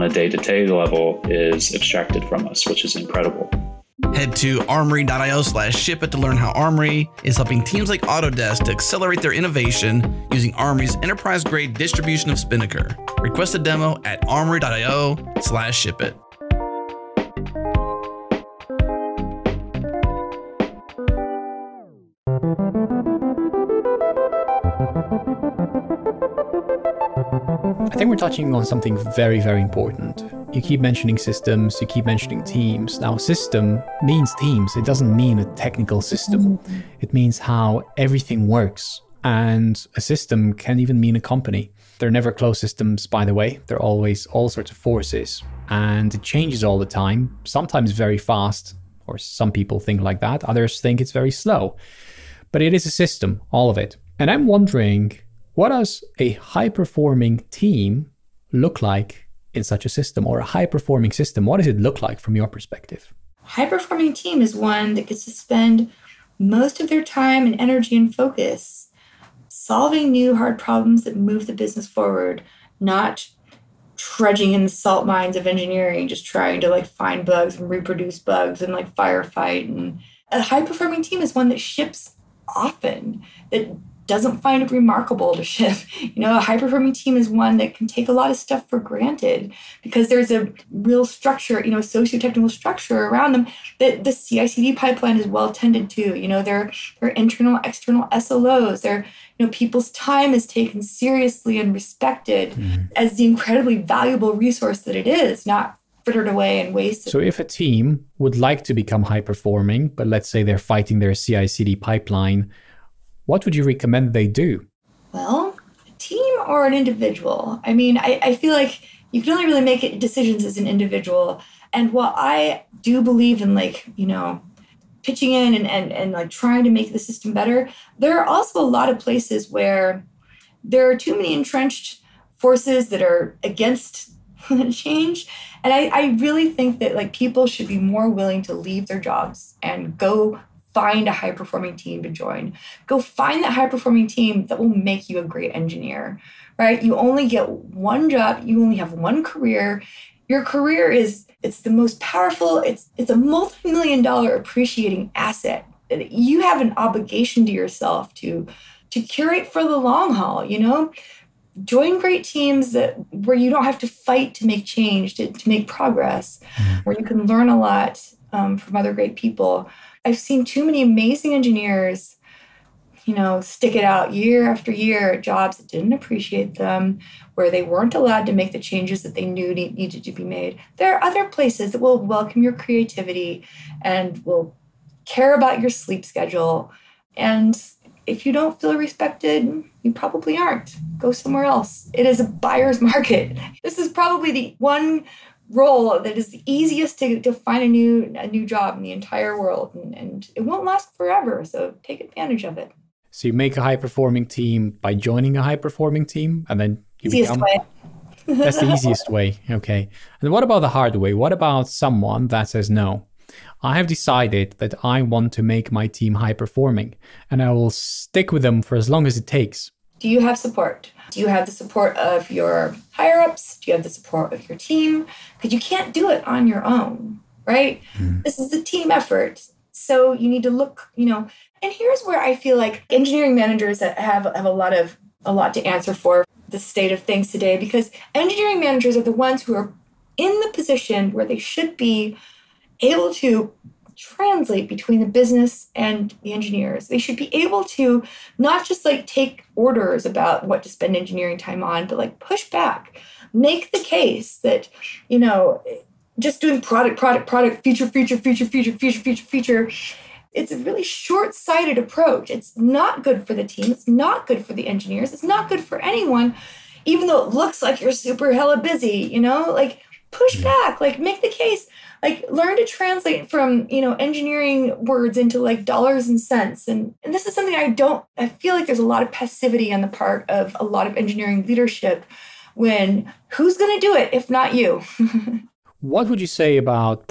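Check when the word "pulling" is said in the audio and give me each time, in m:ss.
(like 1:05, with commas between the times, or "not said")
not said.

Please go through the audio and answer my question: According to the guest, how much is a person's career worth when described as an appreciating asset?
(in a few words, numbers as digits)
multi-million dollar.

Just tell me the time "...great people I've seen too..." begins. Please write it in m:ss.
2:48.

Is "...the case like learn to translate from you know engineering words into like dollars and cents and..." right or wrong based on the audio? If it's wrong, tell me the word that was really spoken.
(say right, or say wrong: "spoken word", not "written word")
right.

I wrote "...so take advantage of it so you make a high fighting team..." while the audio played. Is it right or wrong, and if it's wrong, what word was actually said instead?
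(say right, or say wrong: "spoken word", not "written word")
wrong: "performing", not "fighting".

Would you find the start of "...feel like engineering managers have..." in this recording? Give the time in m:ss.
3:52.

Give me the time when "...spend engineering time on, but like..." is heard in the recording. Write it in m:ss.
4:10.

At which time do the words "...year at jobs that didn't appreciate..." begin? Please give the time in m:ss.
2:54.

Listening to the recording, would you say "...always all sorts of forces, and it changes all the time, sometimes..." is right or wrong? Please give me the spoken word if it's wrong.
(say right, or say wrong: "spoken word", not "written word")
right.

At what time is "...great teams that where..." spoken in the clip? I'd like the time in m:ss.
2:41.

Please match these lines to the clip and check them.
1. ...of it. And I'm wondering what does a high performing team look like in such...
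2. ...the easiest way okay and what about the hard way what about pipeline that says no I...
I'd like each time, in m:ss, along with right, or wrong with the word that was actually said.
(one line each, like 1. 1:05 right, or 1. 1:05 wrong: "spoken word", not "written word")
1. 0:53 right
2. 3:28 wrong: "someone", not "pipeline".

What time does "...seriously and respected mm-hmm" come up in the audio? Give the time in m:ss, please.
1:40.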